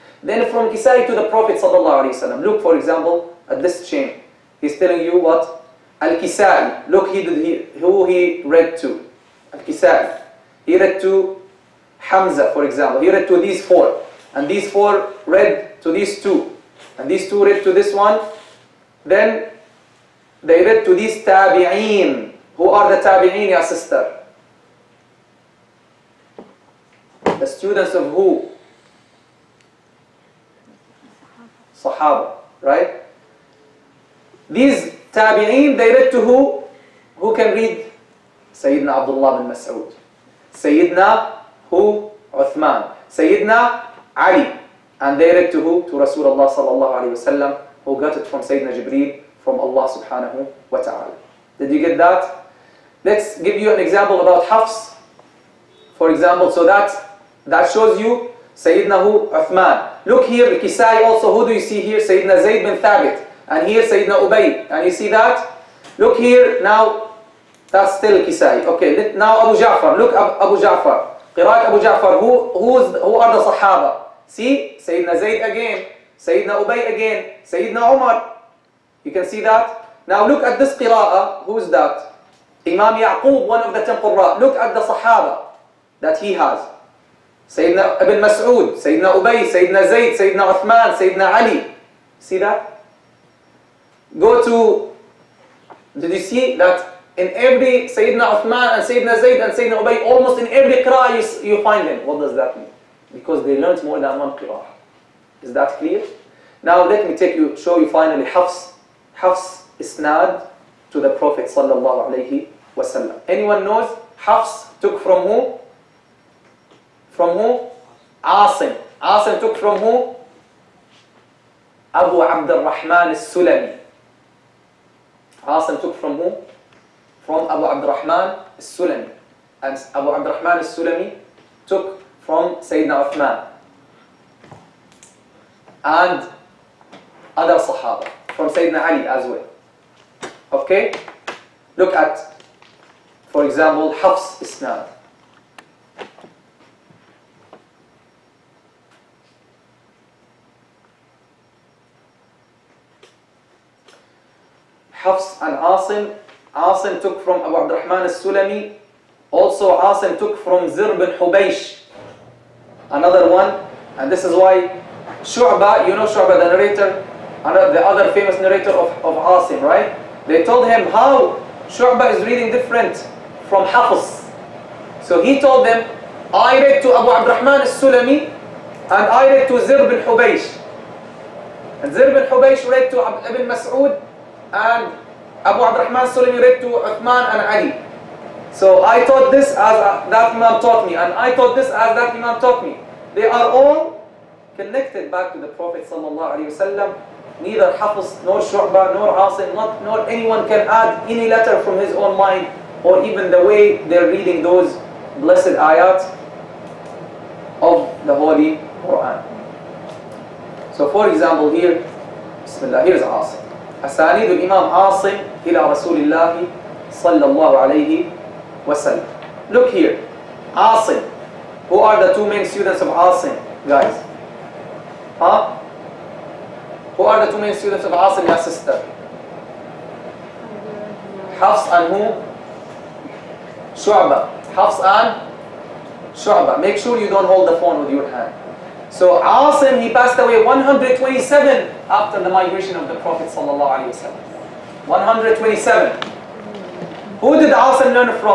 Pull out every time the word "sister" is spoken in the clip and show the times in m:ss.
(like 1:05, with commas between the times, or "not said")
0:23, 3:48.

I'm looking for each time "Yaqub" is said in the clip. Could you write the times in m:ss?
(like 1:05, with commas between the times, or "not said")
1:22.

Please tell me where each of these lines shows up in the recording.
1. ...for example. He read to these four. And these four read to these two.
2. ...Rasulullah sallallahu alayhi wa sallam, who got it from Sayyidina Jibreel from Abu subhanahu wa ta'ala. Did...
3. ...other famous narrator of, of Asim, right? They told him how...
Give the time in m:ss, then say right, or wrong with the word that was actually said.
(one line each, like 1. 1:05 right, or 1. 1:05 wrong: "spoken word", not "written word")
1. 0:12 right
2. 0:46 wrong: "Allah", not "Abu"
3. 2:47 right.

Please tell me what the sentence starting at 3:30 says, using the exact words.
So for example here, Bismillah, here's Asim.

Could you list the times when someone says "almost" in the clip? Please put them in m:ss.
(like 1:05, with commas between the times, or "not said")
1:40.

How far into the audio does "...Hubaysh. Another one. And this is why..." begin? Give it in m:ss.
2:41.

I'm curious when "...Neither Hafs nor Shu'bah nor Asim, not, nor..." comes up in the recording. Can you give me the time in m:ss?
3:17.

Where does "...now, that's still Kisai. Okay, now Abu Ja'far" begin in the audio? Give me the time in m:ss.
1:06.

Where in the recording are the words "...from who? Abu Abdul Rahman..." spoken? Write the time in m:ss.
1:59.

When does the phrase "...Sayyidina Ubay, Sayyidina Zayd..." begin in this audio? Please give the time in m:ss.
1:28.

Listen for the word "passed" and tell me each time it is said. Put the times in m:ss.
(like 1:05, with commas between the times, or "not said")
3:59.